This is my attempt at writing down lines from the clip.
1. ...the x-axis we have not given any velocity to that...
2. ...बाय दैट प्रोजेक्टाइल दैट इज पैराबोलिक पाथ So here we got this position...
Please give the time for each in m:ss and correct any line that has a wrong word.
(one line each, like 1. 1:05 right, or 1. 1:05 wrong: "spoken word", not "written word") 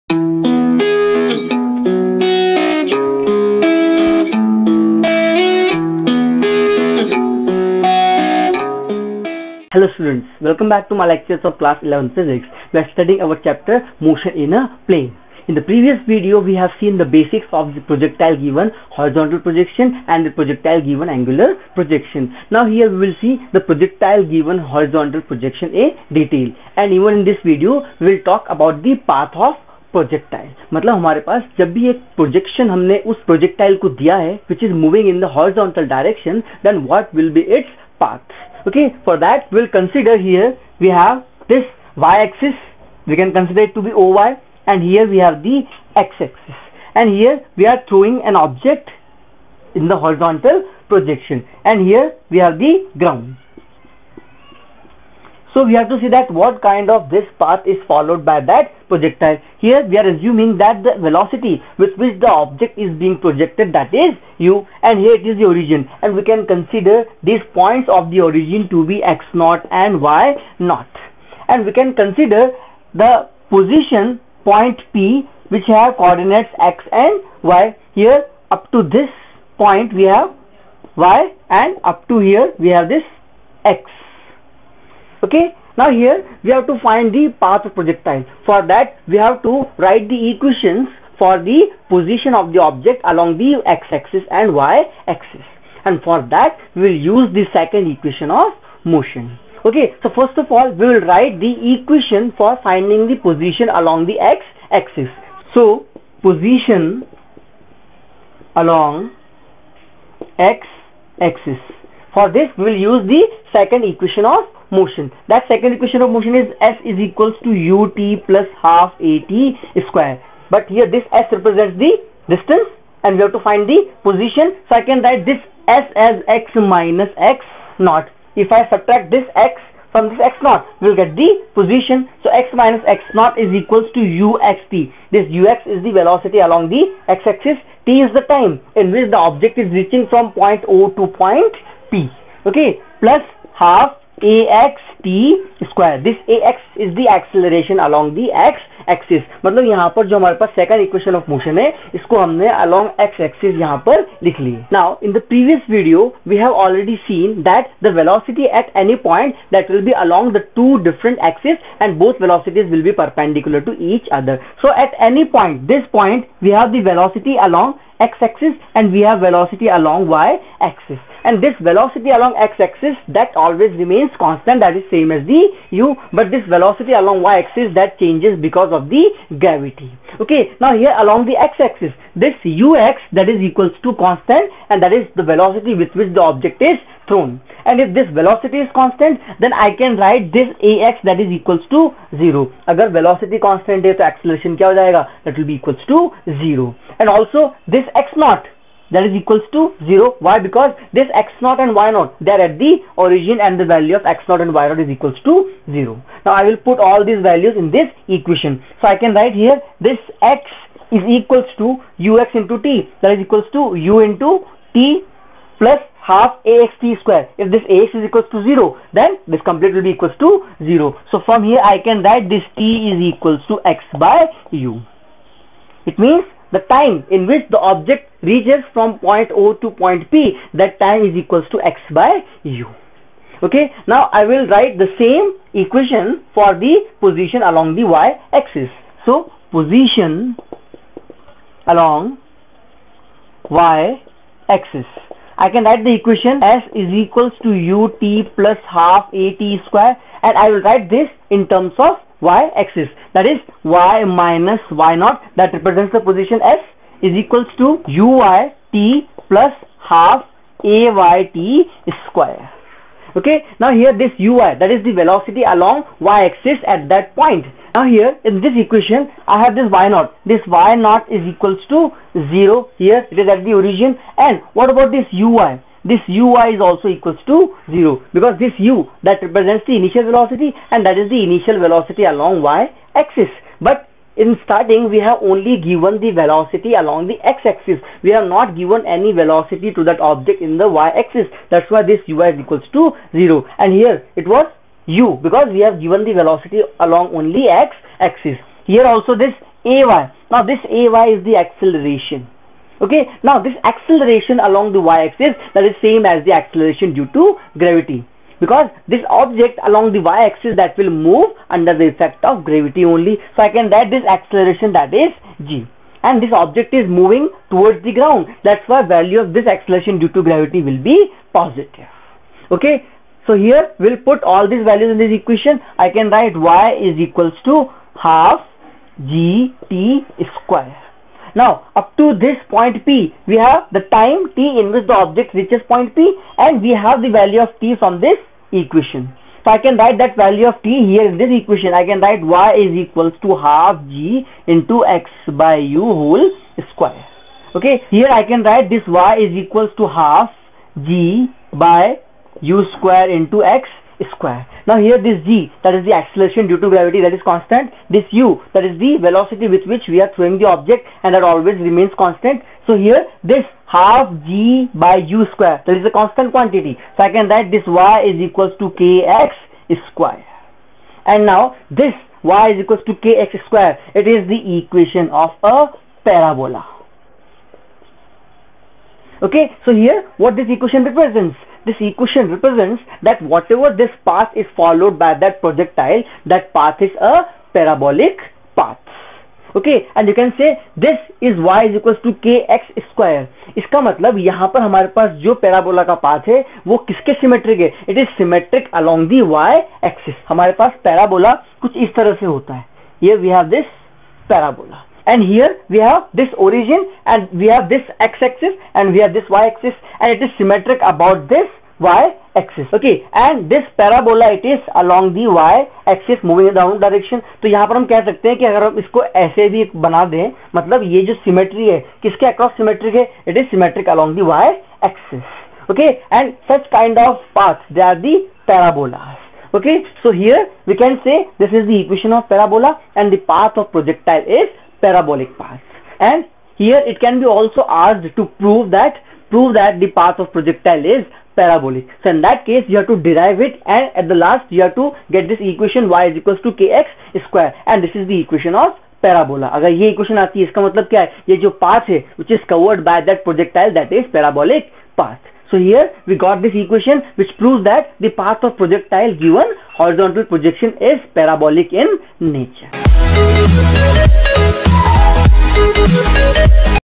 1. 4:47 right
2. 7:32 wrong: "equation", not "position".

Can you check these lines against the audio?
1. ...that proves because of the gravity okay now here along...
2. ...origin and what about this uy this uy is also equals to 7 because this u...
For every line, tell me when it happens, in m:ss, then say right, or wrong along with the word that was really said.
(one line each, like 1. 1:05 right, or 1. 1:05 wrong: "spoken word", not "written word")
1. 2:57 wrong: "changes", not "proves"
2. 4:33 wrong: "0", not "7".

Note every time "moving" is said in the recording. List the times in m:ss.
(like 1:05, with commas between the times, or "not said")
5:16, 6:56.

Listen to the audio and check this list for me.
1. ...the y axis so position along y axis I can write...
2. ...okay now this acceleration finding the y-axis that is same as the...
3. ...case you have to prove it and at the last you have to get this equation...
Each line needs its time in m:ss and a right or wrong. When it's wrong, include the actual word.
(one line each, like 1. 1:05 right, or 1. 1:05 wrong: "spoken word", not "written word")
1. 3:57 right
2. 5:02 wrong: "along", not "finding"
3. 7:22 wrong: "derive", not "prove".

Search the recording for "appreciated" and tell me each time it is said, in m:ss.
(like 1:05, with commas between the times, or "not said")
not said.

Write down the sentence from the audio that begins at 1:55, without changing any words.
That second equation of motion is S is equals to ut plus half at square.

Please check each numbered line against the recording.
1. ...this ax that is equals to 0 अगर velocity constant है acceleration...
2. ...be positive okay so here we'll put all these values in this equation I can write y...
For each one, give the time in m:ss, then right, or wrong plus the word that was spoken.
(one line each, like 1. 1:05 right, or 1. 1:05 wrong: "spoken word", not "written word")
1. 3:10 right
2. 5:20 right.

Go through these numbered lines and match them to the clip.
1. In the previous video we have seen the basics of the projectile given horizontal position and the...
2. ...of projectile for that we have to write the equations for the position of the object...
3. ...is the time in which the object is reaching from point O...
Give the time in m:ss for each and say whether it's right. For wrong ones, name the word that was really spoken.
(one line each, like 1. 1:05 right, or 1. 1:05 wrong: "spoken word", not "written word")
1. 0:15 wrong: "projection", not "position"
2. 1:27 right
3. 2:17 right.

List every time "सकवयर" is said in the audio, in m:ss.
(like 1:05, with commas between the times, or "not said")
2:25, 6:32.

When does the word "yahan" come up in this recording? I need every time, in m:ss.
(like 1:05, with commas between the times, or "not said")
6:57.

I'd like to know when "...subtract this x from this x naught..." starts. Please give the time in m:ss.
2:08.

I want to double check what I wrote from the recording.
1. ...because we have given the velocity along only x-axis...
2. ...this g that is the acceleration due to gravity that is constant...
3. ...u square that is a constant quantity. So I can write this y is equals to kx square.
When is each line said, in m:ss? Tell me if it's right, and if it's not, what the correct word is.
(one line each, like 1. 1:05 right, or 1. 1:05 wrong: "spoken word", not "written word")
1. 4:55 right
2. 5:54 right
3. 6:05 right.